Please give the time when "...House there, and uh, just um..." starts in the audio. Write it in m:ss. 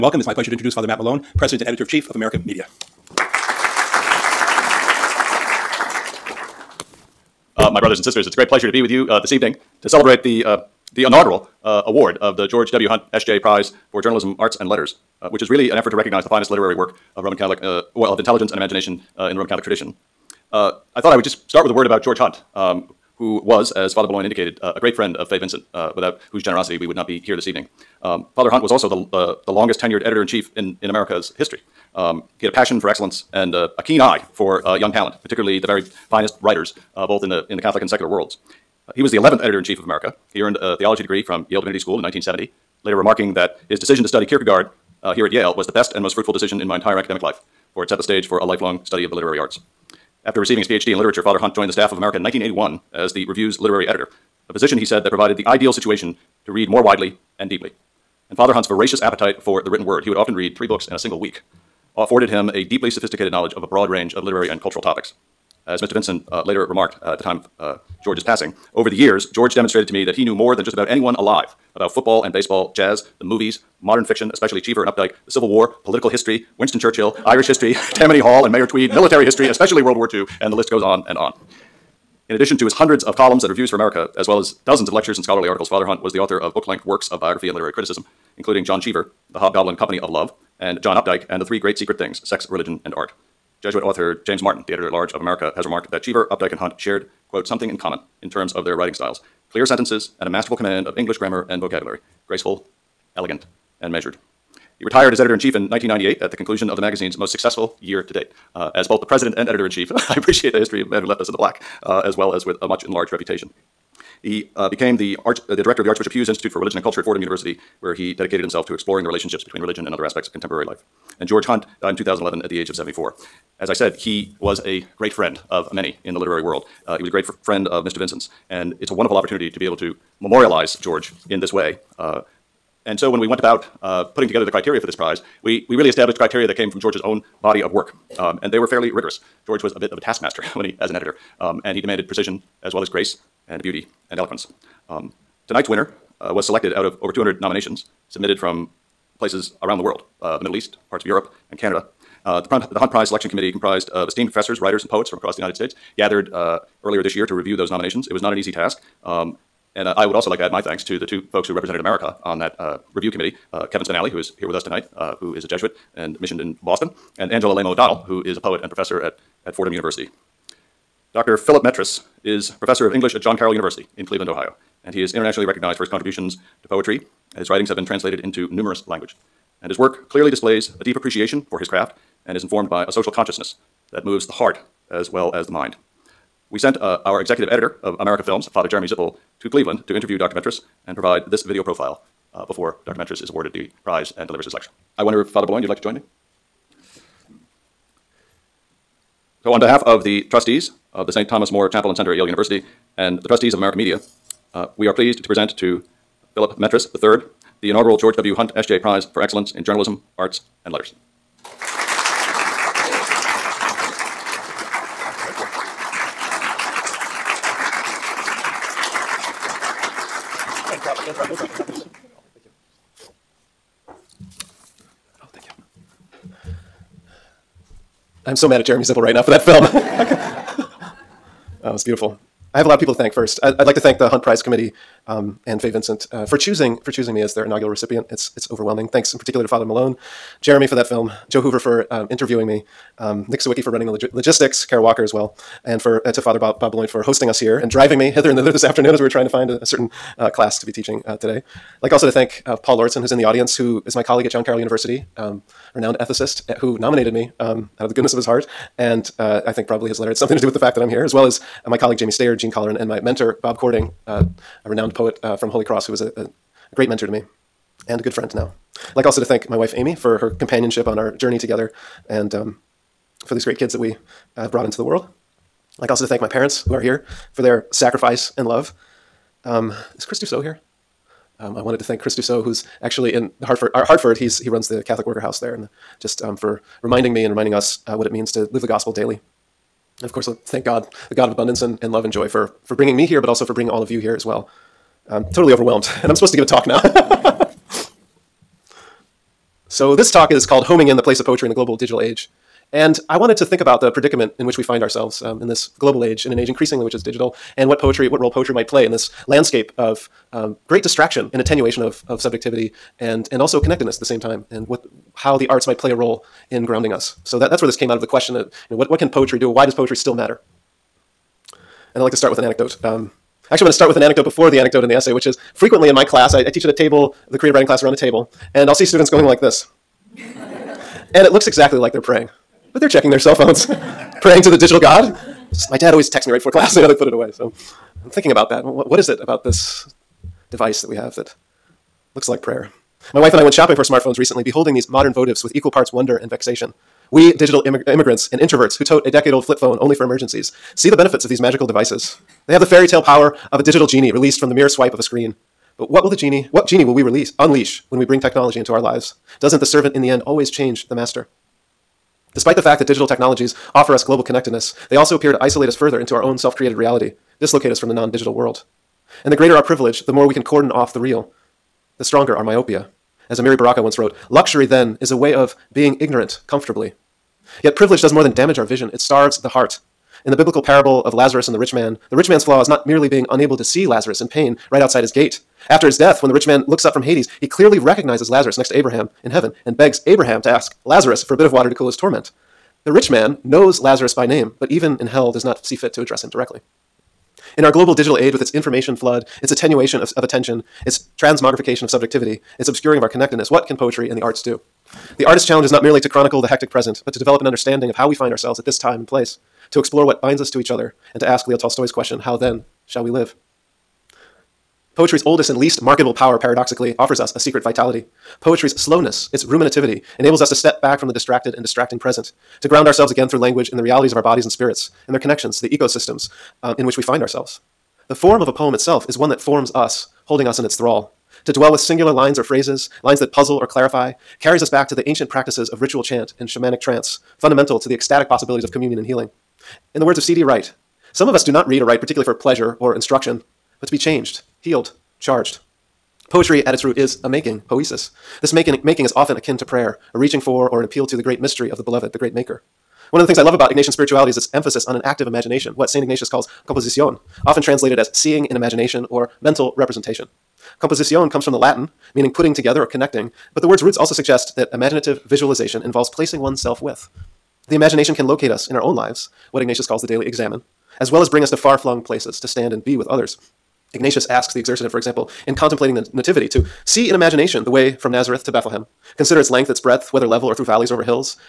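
4:45.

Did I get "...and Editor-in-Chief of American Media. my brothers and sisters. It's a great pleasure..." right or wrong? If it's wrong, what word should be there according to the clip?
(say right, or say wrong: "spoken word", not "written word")
right.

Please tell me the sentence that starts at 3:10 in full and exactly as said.
Metres and provide this video profile uh, before Dr.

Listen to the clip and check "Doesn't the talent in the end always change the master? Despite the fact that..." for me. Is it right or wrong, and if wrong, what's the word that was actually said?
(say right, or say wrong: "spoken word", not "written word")
wrong: "servant", not "talent".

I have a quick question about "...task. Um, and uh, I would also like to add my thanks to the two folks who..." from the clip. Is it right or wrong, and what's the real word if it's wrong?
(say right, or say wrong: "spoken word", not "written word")
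right.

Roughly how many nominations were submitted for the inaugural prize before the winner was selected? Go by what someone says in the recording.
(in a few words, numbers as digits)
200.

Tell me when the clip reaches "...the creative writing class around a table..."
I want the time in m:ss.
5:27.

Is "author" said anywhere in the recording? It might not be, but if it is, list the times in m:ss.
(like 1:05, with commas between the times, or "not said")
1:26, 1:33.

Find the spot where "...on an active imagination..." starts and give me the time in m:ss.
7:34.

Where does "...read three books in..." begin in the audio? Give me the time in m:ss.
1:00.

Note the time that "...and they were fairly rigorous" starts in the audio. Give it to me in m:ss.
2:18.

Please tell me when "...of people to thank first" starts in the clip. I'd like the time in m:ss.
3:52.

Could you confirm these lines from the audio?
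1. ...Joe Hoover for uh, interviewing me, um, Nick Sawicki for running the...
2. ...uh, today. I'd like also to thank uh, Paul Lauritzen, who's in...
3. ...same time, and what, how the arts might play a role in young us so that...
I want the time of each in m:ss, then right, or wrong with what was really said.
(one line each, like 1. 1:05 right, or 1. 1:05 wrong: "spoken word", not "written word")
1. 4:01 right
2. 4:11 right
3. 5:14 wrong: "grounding", not "young".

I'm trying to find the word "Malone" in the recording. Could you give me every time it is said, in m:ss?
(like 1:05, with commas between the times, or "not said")
0:00, 3:59.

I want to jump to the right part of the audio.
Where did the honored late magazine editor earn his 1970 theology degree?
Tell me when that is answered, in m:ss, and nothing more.
0:41.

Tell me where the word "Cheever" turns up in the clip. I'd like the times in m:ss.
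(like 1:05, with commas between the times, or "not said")
1:14, 1:28, 1:36.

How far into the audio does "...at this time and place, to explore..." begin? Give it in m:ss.
6:48.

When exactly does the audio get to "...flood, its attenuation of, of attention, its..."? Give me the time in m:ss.
6:38.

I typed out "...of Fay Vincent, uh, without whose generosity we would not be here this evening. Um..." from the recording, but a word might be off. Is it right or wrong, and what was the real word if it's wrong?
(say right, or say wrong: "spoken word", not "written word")
right.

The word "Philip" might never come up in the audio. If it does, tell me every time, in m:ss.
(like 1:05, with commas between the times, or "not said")
2:51, 3:26.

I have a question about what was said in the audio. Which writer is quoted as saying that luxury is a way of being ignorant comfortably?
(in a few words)
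Amiri Baraka.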